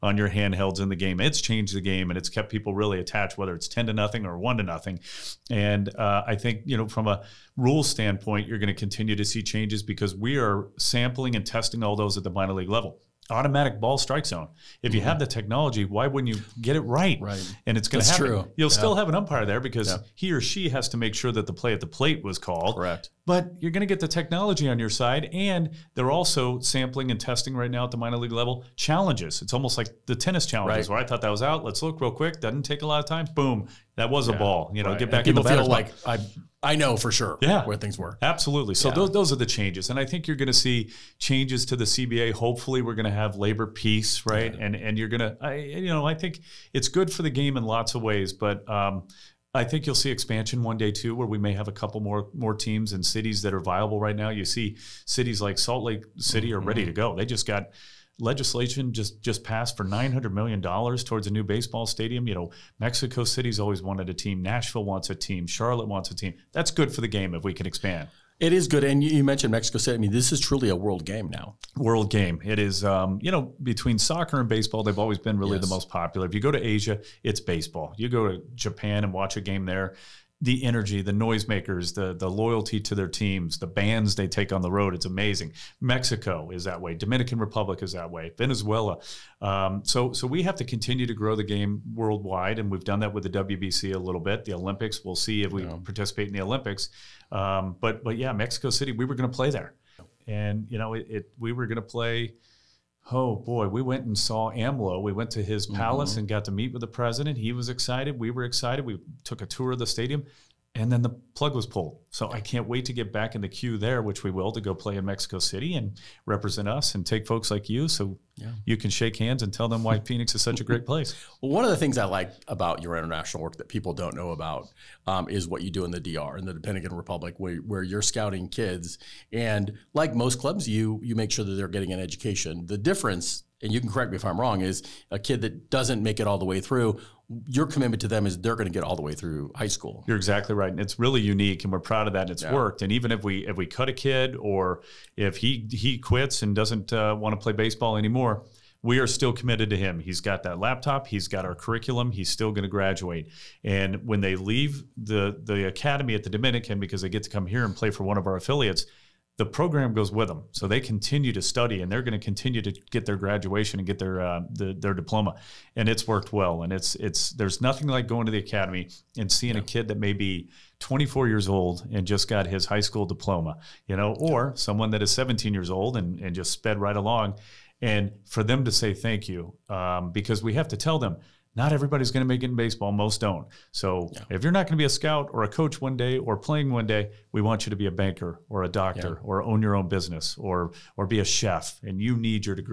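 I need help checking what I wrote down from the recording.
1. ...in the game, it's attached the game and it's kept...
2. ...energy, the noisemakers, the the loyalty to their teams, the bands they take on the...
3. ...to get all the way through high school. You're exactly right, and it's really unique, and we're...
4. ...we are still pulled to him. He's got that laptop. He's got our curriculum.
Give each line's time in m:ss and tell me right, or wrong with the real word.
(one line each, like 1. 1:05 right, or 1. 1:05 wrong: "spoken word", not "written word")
1. 0:00 wrong: "changed", not "attached"
2. 1:20 right
3. 2:18 right
4. 2:28 wrong: "committed", not "pulled".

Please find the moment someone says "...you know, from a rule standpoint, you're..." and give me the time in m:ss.
0:06.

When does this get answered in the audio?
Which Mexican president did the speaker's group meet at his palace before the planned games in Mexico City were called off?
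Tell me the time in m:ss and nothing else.
1:44.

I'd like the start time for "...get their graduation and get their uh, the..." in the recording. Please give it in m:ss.
2:42.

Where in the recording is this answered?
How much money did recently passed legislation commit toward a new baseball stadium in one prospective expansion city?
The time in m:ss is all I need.
0:59.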